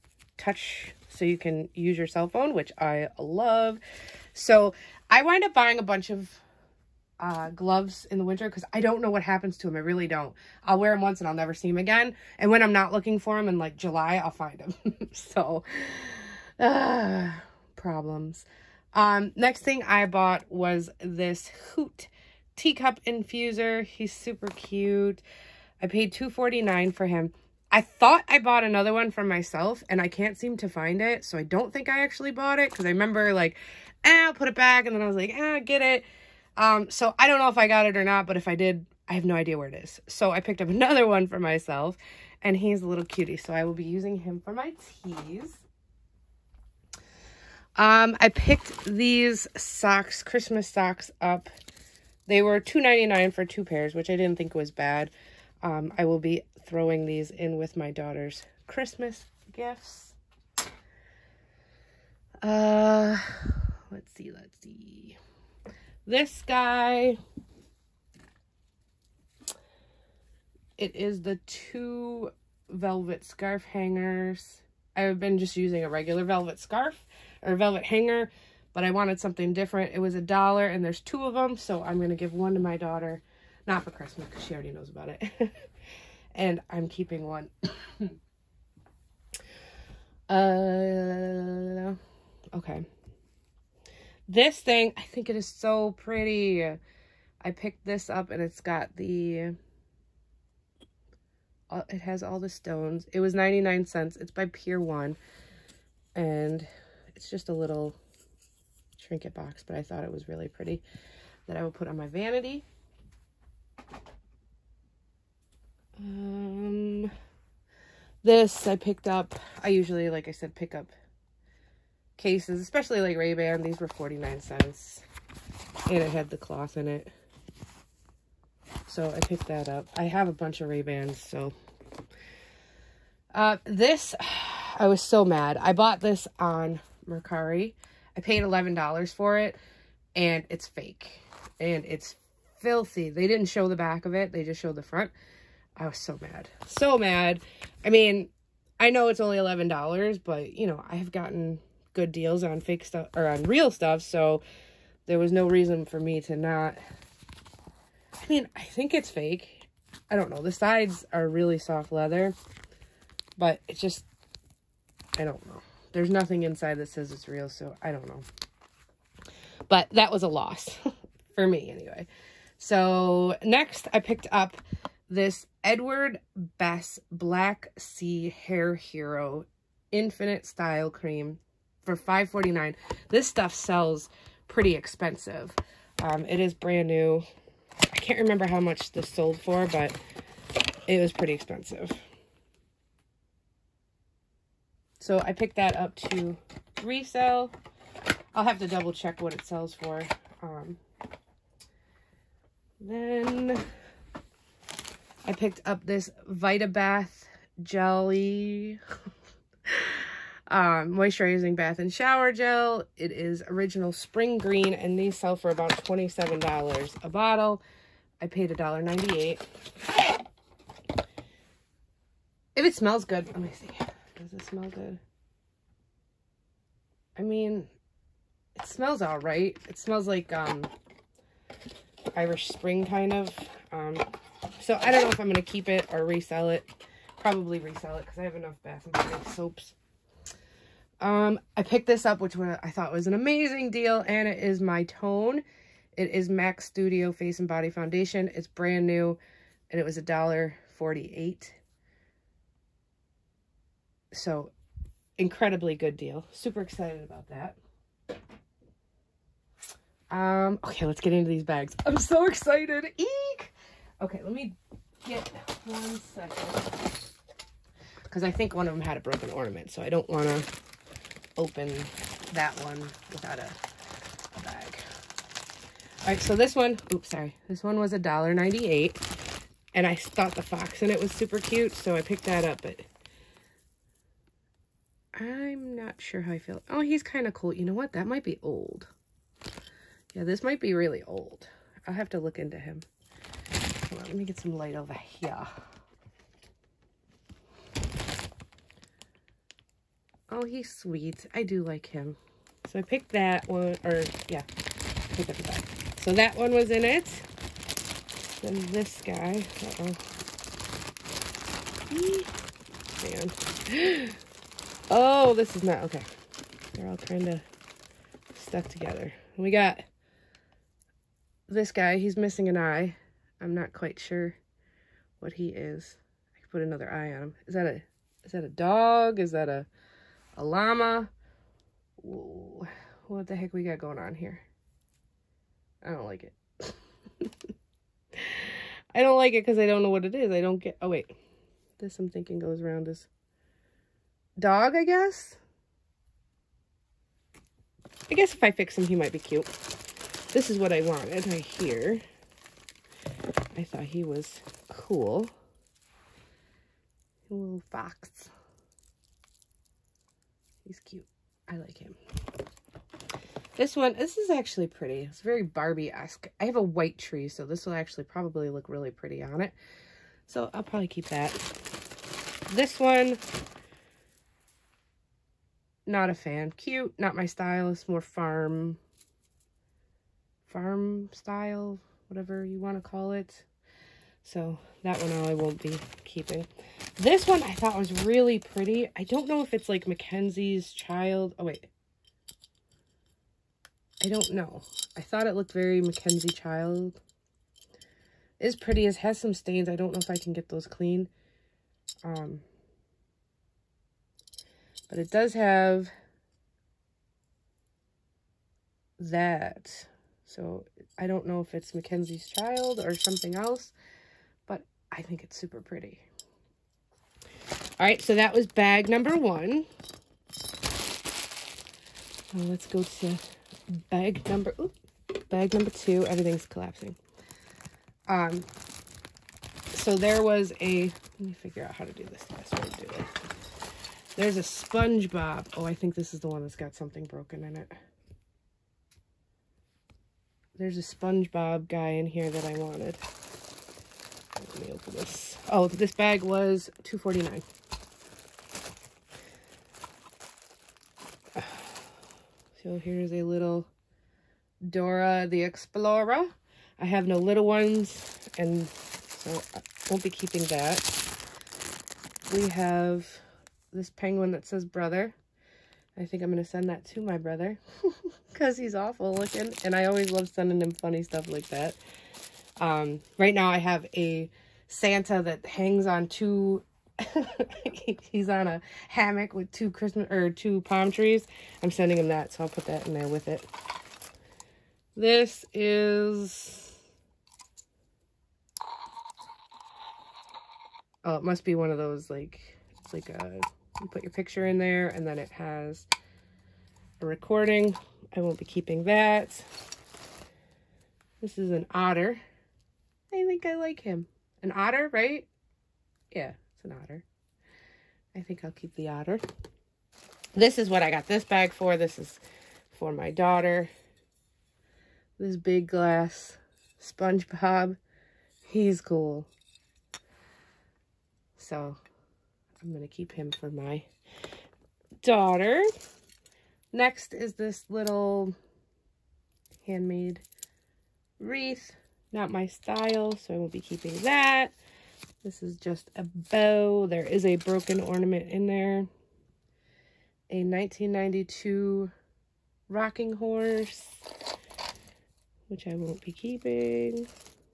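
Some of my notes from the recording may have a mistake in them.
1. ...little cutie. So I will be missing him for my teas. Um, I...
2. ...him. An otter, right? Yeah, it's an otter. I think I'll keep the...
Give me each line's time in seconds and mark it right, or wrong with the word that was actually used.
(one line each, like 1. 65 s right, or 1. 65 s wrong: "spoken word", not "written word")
1. 42 s wrong: "using", not "missing"
2. 503 s right.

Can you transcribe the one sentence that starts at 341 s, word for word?
This I'm thinking goes around as dog, I guess.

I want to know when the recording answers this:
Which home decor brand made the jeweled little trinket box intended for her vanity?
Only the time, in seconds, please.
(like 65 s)
104 s.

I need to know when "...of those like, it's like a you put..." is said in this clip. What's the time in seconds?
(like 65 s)
491 s.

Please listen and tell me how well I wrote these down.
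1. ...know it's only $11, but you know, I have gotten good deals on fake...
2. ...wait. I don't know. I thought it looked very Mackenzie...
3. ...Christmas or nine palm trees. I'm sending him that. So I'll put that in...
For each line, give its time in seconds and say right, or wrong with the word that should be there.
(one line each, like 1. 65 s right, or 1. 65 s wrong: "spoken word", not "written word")
1. 148 s right
2. 391 s right
3. 479 s wrong: "two", not "nine".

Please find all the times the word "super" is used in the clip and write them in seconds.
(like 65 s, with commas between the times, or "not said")
24 s, 256 s, 281 s, 415 s.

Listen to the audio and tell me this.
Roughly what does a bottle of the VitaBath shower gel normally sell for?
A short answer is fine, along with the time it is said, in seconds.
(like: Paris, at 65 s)
$27, at 215 s.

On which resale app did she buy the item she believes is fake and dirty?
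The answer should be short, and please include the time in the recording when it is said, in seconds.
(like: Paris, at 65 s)
Mercari, at 137 s.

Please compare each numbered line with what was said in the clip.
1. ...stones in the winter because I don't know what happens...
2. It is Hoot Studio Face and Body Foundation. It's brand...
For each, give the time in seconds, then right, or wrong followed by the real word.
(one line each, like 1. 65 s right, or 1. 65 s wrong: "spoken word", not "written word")
1. 7 s wrong: "gloves", not "stones"
2. 245 s wrong: "MAC", not "Hoot".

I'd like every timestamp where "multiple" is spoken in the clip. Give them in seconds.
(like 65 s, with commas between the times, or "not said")
not said.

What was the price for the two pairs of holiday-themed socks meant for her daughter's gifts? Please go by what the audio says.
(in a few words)
$2.99.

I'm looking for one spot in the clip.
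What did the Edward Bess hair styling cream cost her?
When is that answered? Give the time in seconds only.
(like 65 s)
181 s.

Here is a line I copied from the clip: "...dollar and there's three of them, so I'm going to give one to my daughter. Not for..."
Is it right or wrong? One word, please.
wrong.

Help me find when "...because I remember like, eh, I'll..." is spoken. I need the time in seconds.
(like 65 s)
32 s.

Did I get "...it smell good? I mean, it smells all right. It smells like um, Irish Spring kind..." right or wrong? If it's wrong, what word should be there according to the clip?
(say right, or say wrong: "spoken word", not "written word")
right.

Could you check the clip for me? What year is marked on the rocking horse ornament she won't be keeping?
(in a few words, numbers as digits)
1992.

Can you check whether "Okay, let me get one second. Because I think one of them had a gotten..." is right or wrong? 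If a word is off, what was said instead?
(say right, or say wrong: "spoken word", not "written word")
wrong: "broken", not "gotten".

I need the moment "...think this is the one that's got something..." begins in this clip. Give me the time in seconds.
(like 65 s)
435 s.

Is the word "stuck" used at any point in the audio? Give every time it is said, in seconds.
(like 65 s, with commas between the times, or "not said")
318 s.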